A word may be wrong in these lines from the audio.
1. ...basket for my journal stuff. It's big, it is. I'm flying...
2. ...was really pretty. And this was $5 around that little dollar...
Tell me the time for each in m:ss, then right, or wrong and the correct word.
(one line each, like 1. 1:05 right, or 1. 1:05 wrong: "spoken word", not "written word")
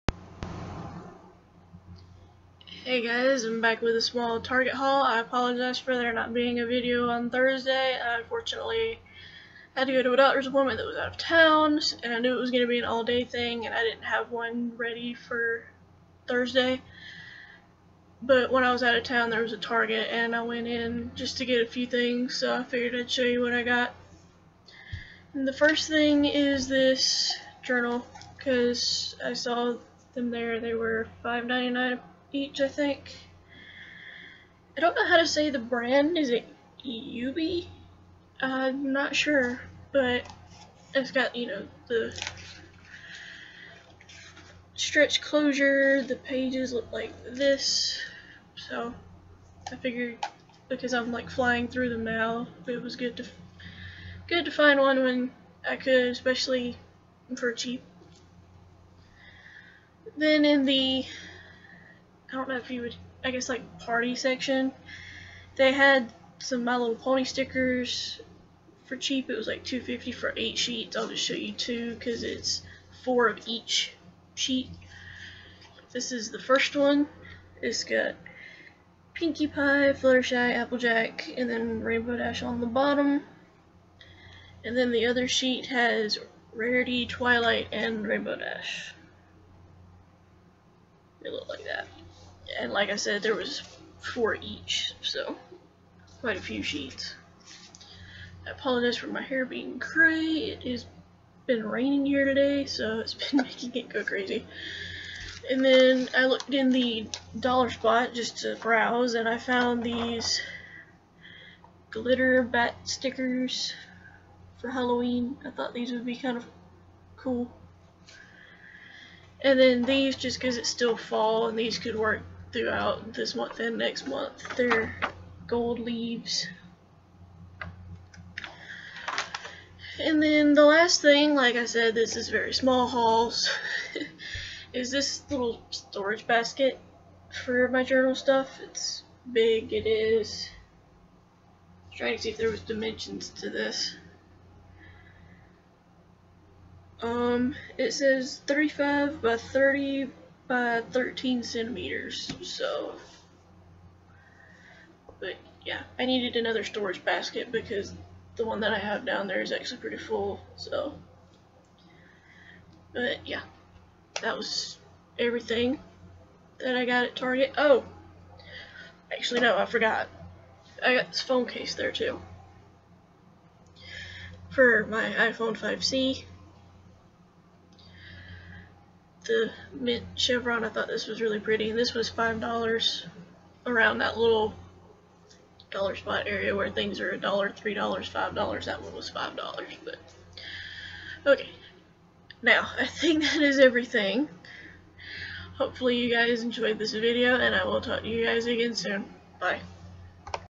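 1. 2:16 wrong: "trying", not "flying"
2. 3:01 right.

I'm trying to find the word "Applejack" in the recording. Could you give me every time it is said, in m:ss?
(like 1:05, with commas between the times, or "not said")
1:20.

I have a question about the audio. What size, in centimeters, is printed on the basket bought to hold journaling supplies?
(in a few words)
35 by 30 by 13 centimeters.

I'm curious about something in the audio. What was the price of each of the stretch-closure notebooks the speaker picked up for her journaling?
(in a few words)
$5.99.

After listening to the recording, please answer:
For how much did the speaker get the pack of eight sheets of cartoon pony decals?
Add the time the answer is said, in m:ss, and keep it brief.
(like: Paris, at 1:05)
$2.50, at 1:09.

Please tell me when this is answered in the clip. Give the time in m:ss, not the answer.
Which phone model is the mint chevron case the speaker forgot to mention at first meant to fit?
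2:55.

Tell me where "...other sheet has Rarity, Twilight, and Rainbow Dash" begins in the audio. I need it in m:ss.
1:25.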